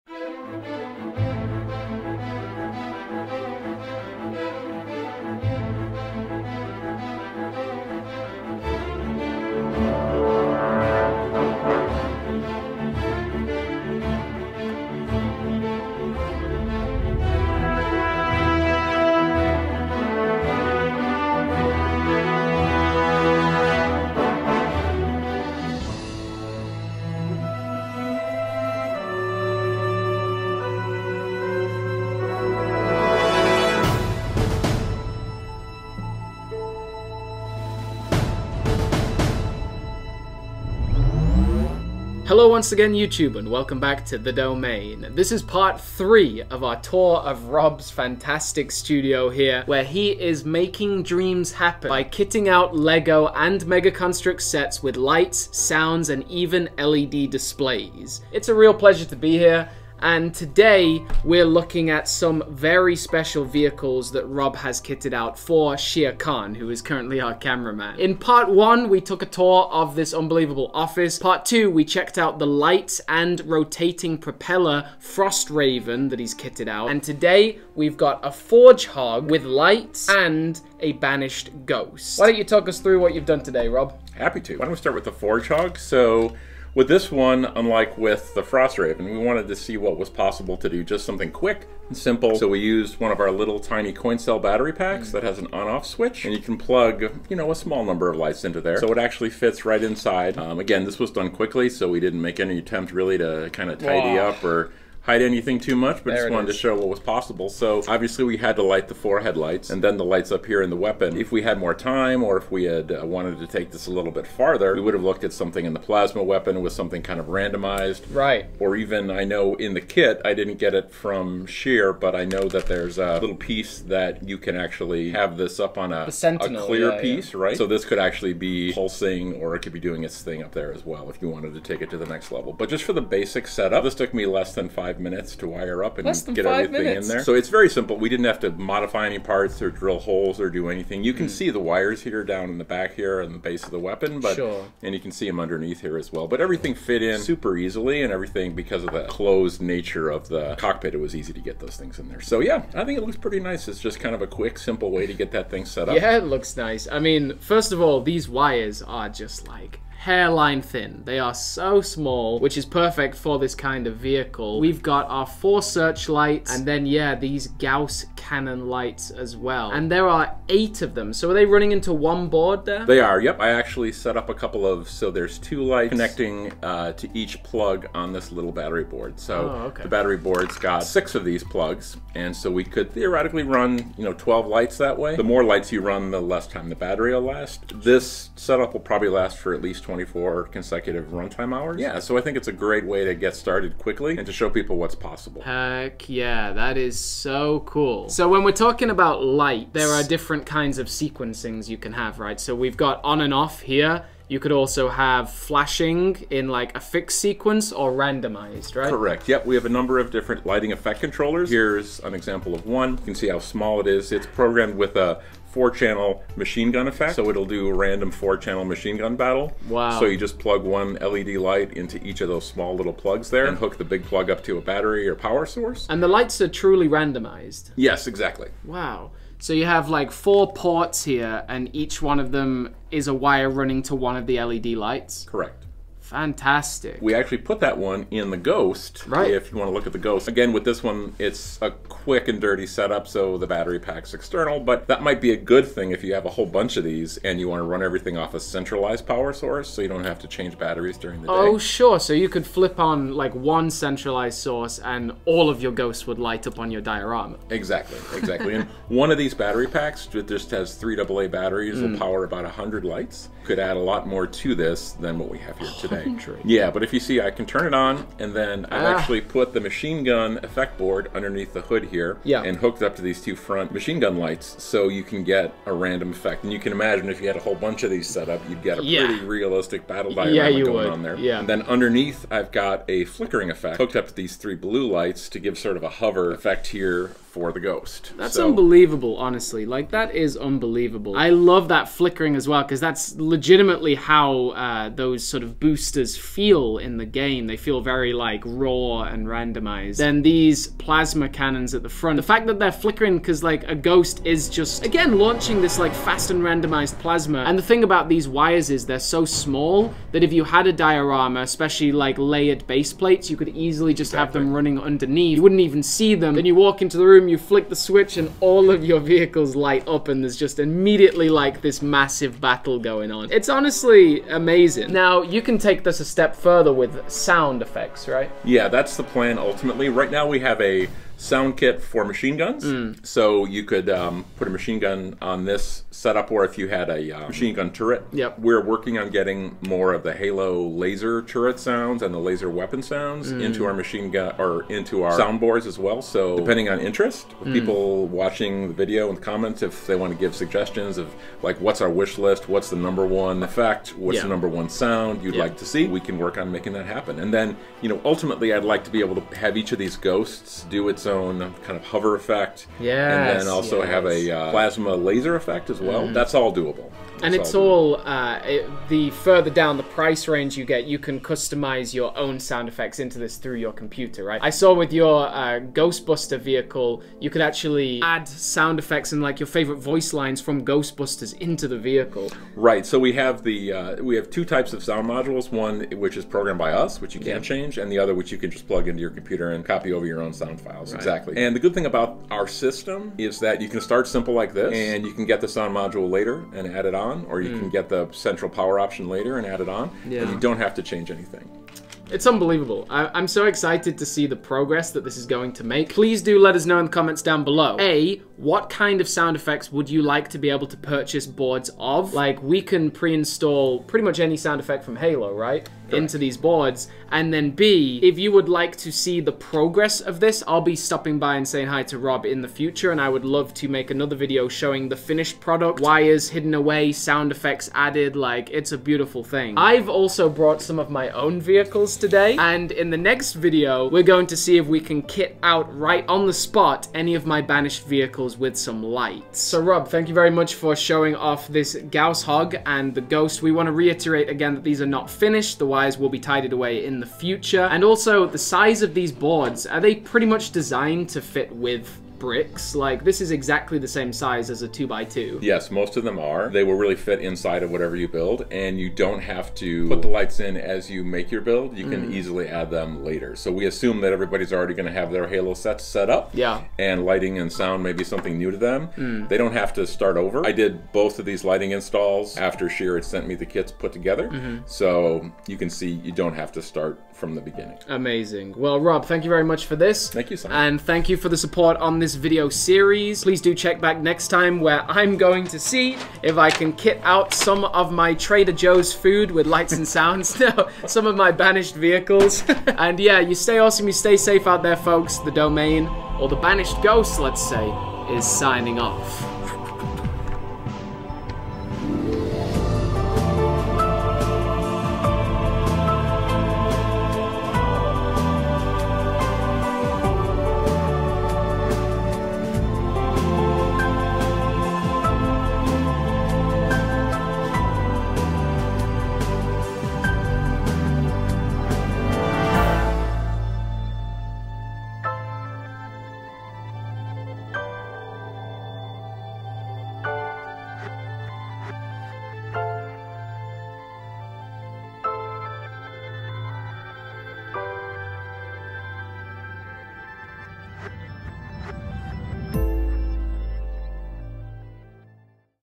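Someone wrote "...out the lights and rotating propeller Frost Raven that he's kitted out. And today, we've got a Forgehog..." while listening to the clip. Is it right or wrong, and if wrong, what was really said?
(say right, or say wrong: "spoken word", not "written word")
right.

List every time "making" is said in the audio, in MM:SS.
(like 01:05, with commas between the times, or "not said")
00:50, 05:56.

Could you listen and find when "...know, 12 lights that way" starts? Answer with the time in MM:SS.
03:04.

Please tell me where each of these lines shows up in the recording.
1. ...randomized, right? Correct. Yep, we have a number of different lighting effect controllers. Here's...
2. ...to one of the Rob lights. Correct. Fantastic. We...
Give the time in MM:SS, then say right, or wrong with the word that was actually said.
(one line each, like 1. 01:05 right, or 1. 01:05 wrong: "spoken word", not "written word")
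1. 03:27 right
2. 03:53 wrong: "LED", not "Rob".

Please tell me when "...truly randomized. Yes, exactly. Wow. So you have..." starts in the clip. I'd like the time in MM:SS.
03:46.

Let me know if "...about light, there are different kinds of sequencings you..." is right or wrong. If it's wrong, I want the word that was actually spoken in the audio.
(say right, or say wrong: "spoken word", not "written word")
right.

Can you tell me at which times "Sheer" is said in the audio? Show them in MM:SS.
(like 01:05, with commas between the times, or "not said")
02:01, 07:52.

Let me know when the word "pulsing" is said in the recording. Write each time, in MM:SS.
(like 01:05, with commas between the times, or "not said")
02:08.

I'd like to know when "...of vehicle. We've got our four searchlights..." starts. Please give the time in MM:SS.
02:43.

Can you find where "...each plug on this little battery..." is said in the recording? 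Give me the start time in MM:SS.
02:57.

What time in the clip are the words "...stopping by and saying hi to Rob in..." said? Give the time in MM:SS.
07:00.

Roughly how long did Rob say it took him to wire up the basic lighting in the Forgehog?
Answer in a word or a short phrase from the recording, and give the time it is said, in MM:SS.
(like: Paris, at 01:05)
less than 5 minutes, at 02:14.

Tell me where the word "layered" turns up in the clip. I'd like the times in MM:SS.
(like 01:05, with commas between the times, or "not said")
05:12.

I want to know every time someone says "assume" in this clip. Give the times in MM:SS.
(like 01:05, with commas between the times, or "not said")
07:43.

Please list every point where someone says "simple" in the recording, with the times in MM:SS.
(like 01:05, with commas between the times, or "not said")
01:31, 02:17, 02:34, 06:34.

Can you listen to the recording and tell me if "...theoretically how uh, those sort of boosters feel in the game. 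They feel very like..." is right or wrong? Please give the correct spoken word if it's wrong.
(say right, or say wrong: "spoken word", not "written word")
wrong: "legitimately", not "theoretically".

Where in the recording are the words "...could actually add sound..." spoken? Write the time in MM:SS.
06:17.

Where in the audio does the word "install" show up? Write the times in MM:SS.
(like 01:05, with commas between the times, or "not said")
06:52, 07:51.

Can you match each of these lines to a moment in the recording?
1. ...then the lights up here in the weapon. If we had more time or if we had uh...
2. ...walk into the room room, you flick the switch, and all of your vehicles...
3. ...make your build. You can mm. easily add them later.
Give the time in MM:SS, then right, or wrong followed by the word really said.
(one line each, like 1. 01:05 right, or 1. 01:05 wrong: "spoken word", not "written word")
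1. 01:49 right
2. 05:16 right
3. 07:41 right.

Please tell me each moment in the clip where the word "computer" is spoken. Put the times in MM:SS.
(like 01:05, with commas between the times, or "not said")
06:13, 06:29.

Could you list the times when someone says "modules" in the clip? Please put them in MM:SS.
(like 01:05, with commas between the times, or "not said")
06:25, 06:35.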